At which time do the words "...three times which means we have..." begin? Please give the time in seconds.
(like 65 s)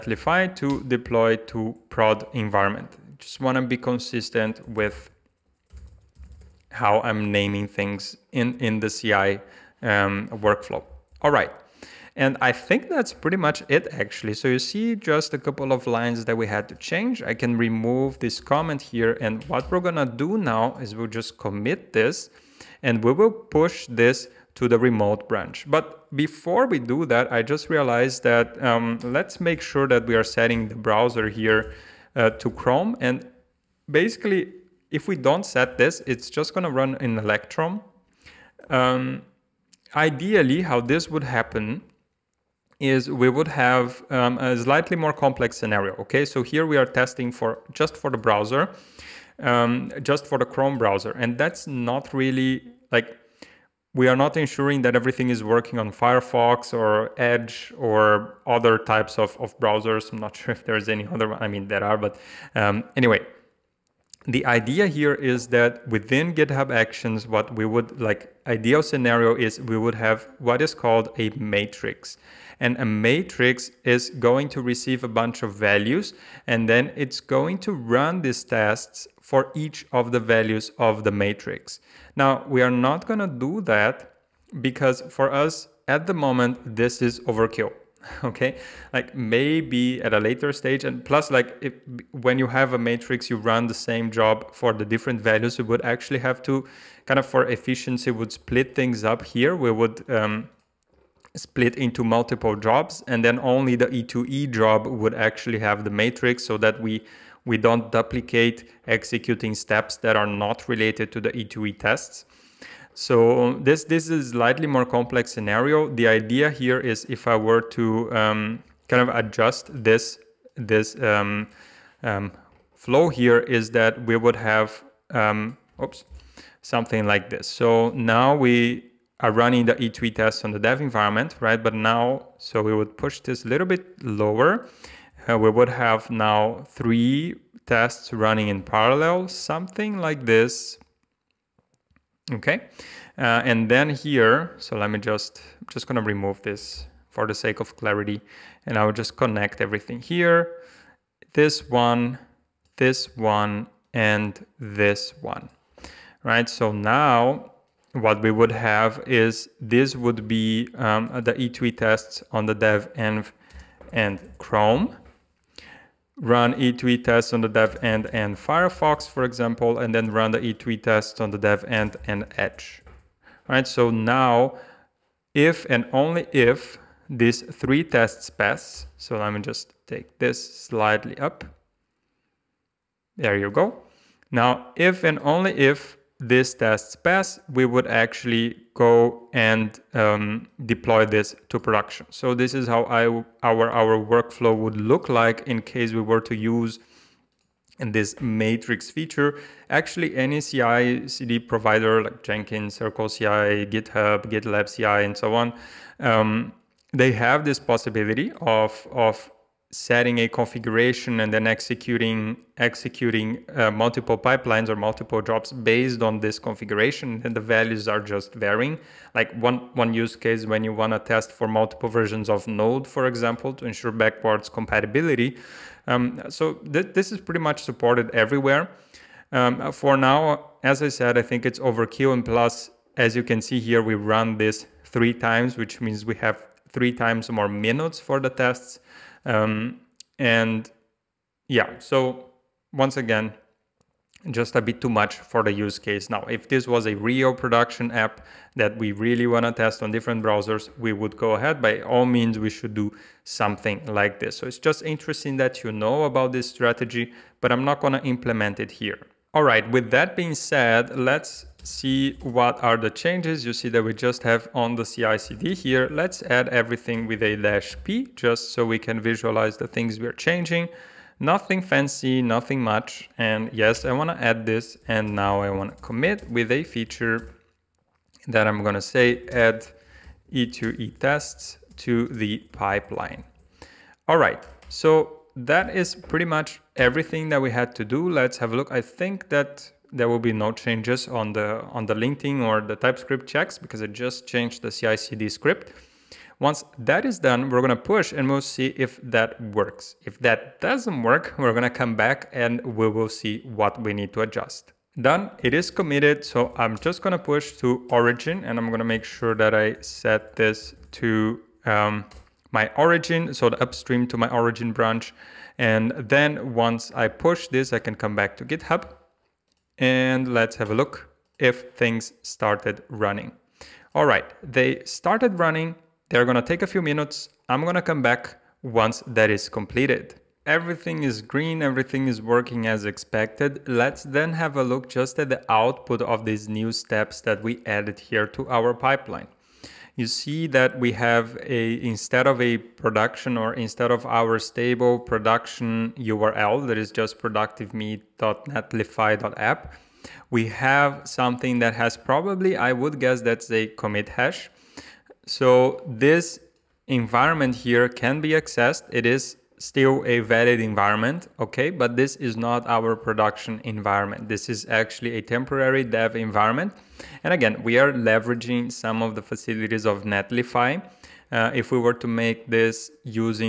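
234 s.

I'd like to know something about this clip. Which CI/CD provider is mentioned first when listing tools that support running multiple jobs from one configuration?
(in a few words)
Jenkins.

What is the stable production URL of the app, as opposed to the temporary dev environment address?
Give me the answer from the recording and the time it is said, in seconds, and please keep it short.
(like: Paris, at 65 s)
productivemeet.netlify.app, at 347 s.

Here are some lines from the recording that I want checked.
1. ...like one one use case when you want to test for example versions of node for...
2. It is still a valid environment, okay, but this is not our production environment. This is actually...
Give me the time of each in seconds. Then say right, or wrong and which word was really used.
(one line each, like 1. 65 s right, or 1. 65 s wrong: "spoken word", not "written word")
1. 219 s wrong: "multiple", not "example"
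2. 358 s right.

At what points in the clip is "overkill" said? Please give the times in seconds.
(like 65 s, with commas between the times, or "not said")
87 s, 231 s.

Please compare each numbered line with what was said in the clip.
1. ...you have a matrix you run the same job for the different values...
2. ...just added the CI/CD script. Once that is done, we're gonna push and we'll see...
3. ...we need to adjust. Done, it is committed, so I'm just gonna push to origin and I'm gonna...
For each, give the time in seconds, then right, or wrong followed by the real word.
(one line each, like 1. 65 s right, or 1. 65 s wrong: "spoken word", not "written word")
1. 92 s right
2. 293 s wrong: "changed", not "added"
3. 303 s right.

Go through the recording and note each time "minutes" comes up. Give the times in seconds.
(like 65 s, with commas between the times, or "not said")
237 s, 326 s.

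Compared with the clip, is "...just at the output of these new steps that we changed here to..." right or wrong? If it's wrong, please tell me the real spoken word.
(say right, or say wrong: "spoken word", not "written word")
wrong: "added", not "changed".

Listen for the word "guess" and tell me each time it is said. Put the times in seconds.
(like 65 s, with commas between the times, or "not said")
352 s.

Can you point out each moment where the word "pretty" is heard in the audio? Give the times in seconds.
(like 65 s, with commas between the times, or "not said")
13 s, 227 s, 285 s.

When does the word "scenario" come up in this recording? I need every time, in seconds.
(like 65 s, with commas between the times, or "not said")
45 s, 68 s, 115 s.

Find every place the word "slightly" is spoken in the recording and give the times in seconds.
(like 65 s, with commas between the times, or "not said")
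44 s, 114 s, 180 s.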